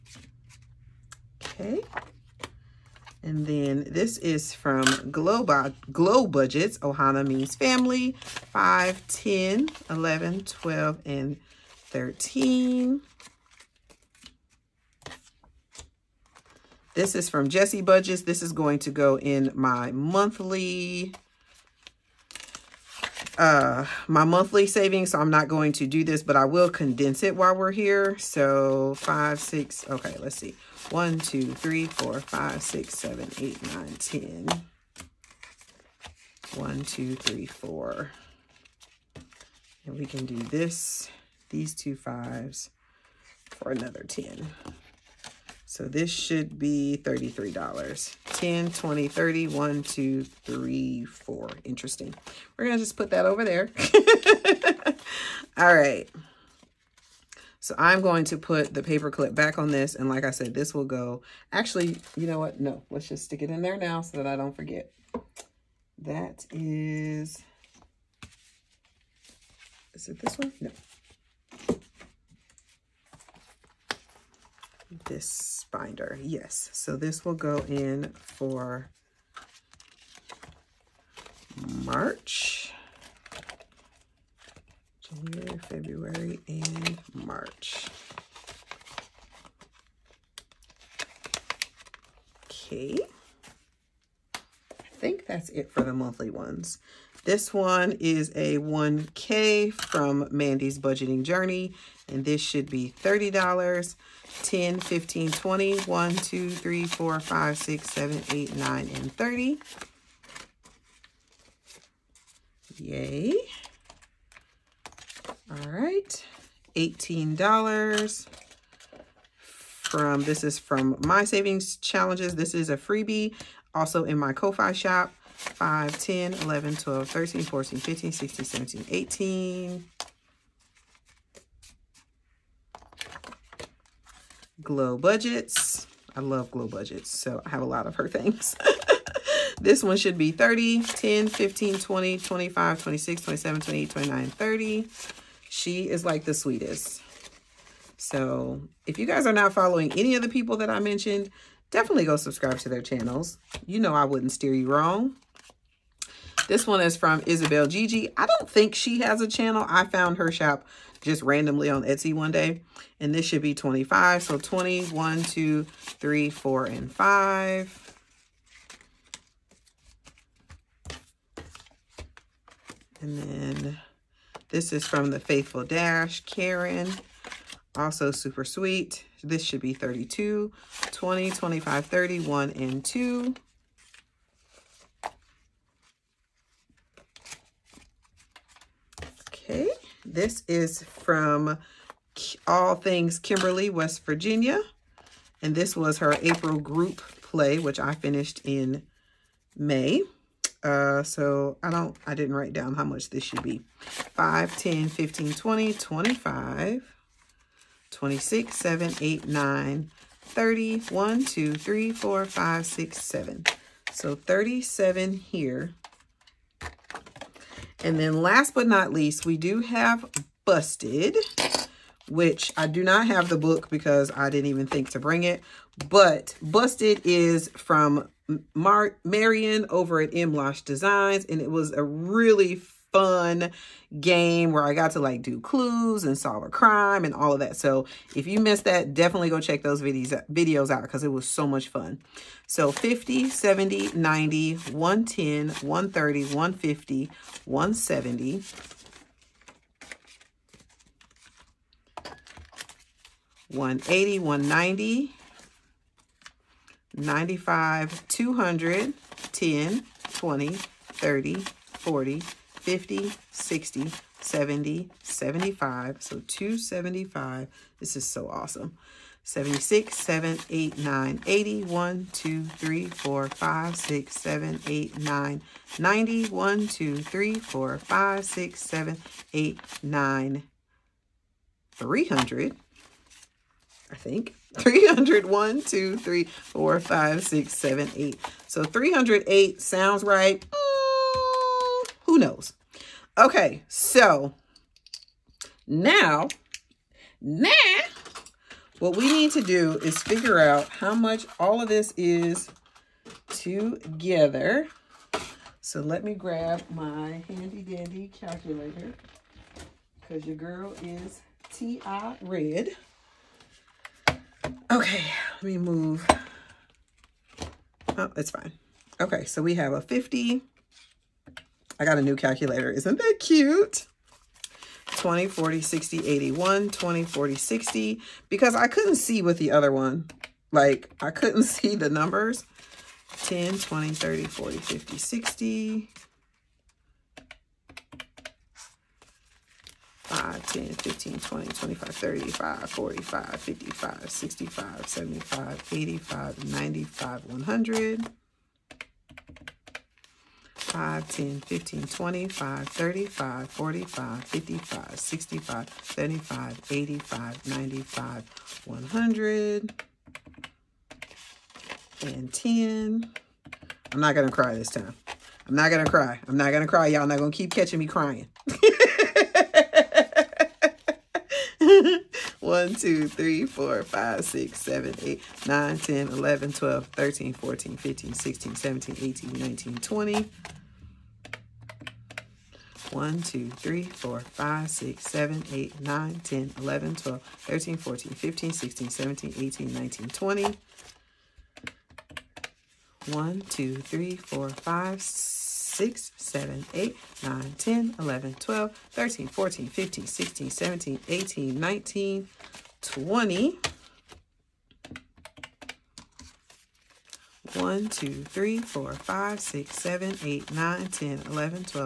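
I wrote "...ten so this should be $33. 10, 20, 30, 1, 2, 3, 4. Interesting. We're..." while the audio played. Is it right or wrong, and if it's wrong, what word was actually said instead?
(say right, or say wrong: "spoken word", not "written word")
right.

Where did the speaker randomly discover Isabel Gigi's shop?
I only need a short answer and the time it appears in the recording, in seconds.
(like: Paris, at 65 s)
Etsy, at 161 s.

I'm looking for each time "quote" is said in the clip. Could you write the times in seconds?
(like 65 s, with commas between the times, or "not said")
not said.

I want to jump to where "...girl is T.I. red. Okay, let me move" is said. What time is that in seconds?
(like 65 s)
310 s.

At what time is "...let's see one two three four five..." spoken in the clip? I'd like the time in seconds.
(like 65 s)
30 s.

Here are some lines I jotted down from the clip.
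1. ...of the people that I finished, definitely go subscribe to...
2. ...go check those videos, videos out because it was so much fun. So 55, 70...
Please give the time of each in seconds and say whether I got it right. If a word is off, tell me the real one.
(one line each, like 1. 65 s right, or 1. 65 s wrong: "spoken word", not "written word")
1. 150 s wrong: "mentioned", not "finished"
2. 239 s wrong: "50", not "55".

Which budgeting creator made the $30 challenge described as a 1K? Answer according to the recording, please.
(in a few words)
Mandy's Budgeting Journey.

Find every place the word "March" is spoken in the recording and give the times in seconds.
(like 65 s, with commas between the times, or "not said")
81 s, 87 s.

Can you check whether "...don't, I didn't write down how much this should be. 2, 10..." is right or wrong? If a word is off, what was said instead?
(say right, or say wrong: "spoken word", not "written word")
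wrong: "5", not "2".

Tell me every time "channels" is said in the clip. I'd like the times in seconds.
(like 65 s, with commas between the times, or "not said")
152 s, 159 s.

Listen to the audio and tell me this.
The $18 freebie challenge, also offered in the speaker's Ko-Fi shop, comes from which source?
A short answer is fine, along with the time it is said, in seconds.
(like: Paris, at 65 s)
My Savings Challenges, at 121 s.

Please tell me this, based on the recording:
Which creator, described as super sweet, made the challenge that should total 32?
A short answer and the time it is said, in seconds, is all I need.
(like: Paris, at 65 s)
the Faithful Dash, at 175 s.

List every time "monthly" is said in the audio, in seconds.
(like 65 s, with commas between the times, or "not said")
19 s, 24 s, 95 s.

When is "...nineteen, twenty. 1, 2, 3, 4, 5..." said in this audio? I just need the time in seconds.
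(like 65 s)
379 s.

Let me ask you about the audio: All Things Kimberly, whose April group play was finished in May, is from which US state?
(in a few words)
West Virginia.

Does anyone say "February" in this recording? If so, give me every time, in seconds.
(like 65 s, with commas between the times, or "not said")
85 s.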